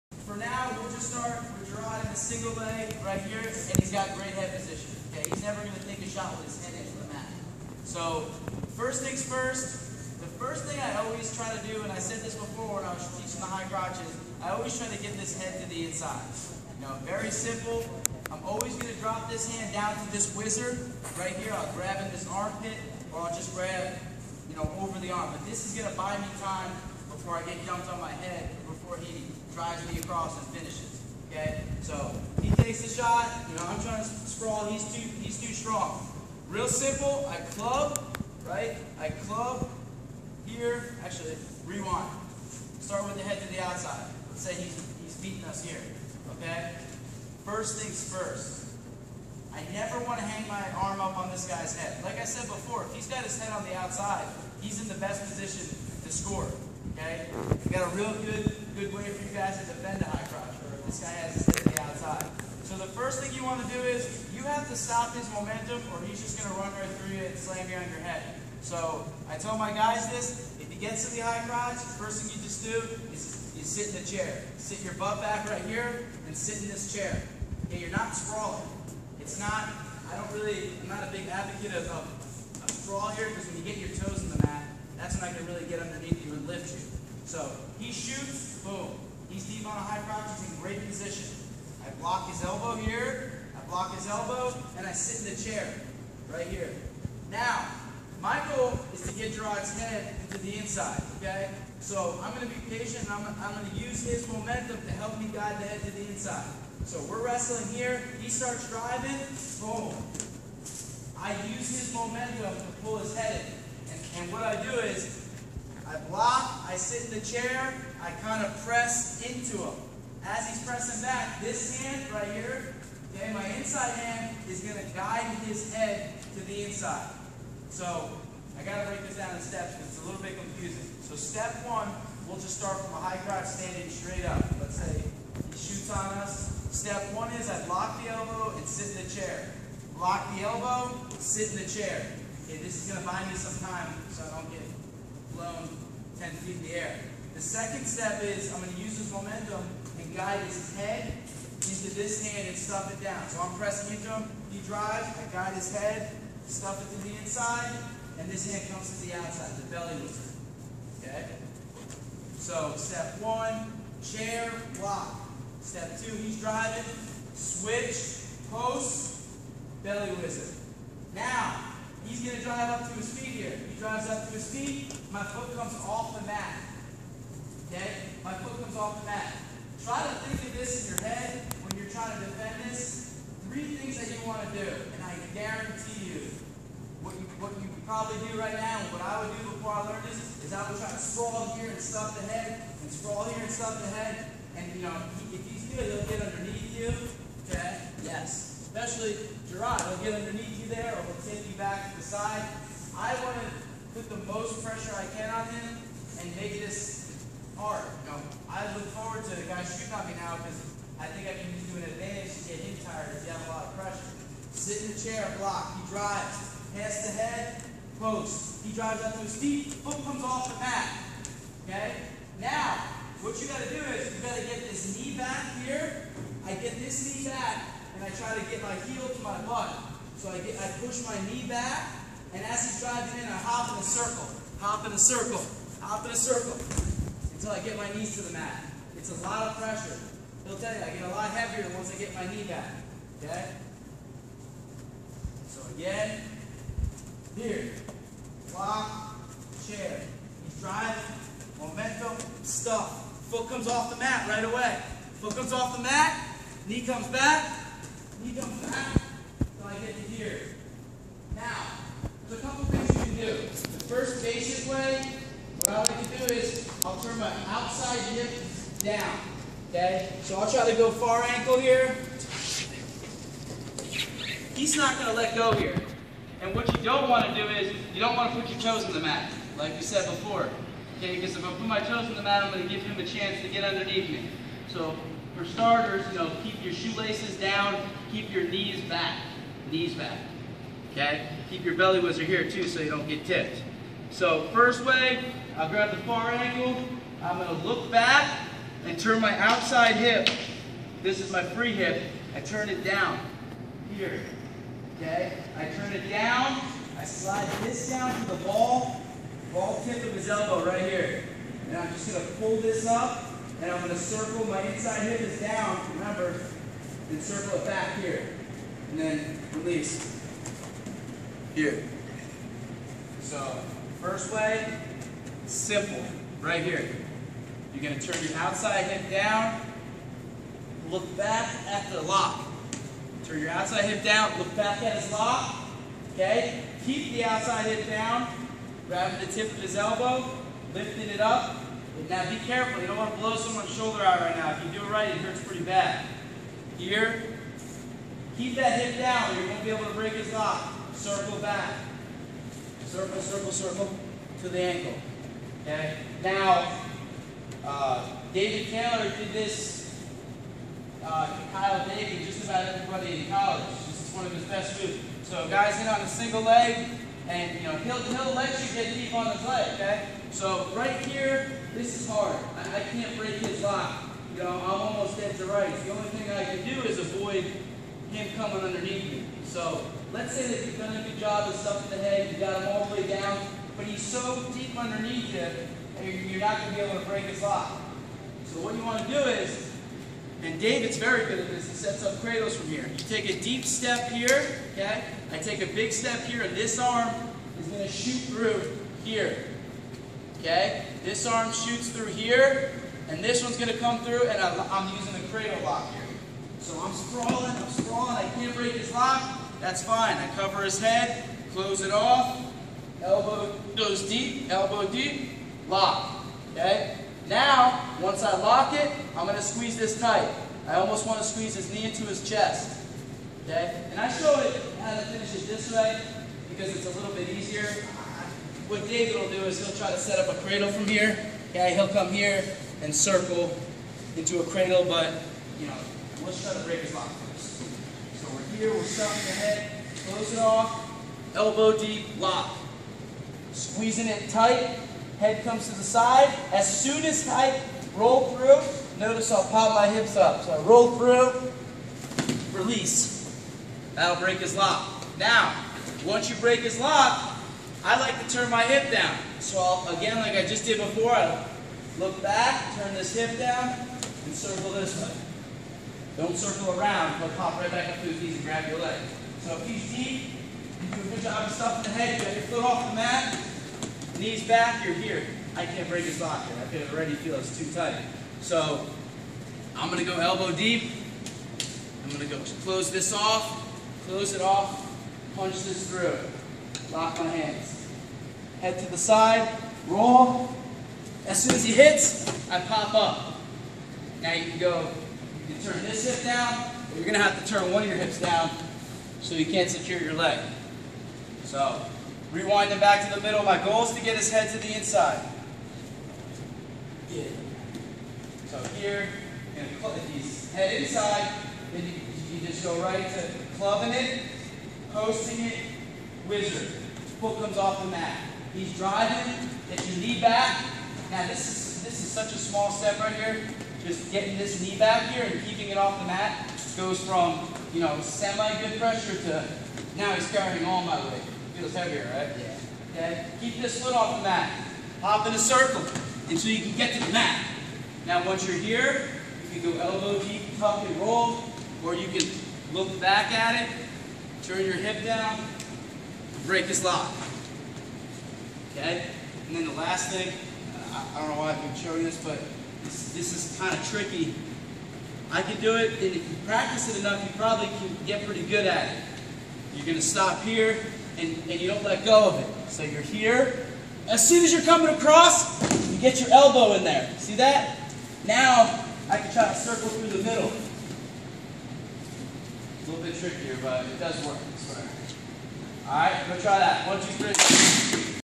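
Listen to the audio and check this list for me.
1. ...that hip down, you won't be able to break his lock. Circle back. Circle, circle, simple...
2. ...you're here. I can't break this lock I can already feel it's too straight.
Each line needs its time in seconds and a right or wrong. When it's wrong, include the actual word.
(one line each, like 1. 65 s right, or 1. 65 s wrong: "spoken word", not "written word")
1. 348 s wrong: "circle", not "simple"
2. 474 s wrong: "tight", not "straight".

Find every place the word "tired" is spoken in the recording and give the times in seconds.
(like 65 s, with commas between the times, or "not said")
212 s.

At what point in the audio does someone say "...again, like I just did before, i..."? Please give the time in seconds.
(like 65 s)
459 s.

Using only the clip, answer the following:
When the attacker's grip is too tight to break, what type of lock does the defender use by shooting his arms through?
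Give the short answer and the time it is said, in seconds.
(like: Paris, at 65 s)
Cradle lock, at 405 s.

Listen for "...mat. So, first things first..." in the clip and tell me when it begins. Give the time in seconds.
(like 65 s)
7 s.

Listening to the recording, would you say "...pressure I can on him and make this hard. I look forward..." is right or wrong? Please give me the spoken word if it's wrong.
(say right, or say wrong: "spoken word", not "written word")
right.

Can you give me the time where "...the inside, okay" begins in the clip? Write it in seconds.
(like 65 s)
100 s.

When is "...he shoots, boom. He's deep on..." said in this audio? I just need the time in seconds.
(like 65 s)
87 s.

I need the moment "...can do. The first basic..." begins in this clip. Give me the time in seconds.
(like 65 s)
263 s.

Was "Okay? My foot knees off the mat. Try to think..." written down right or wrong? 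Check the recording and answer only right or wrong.
wrong.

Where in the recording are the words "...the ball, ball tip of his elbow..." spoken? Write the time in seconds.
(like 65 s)
308 s.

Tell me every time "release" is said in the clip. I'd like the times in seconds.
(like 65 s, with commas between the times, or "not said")
319 s, 452 s.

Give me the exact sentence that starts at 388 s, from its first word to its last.
So what you want to do is, and David's very good at this, he sets up cradles from here.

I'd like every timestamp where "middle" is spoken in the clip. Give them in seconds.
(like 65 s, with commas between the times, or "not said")
503 s, 570 s.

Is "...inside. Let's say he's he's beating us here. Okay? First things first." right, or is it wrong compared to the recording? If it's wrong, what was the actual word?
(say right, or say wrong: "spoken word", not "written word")
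wrong: "outside", not "inside".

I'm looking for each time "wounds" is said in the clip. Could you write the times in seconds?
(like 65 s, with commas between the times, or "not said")
not said.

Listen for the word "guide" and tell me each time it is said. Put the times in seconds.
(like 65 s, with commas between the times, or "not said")
105 s, 124 s, 150 s, 155 s.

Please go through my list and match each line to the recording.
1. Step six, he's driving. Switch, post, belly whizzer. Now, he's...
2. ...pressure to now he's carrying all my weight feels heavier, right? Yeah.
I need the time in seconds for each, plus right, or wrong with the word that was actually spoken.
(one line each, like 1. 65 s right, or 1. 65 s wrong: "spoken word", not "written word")
1. 165 s wrong: "two", not "six"
2. 528 s right.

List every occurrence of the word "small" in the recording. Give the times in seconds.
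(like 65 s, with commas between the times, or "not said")
522 s.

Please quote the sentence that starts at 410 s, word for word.
I cover his head, close it off, elbow goes deep, elbow deep, lock, okay?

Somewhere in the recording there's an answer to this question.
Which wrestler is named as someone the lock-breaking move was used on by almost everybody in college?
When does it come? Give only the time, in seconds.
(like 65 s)
358 s.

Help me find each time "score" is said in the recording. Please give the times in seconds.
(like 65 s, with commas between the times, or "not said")
56 s.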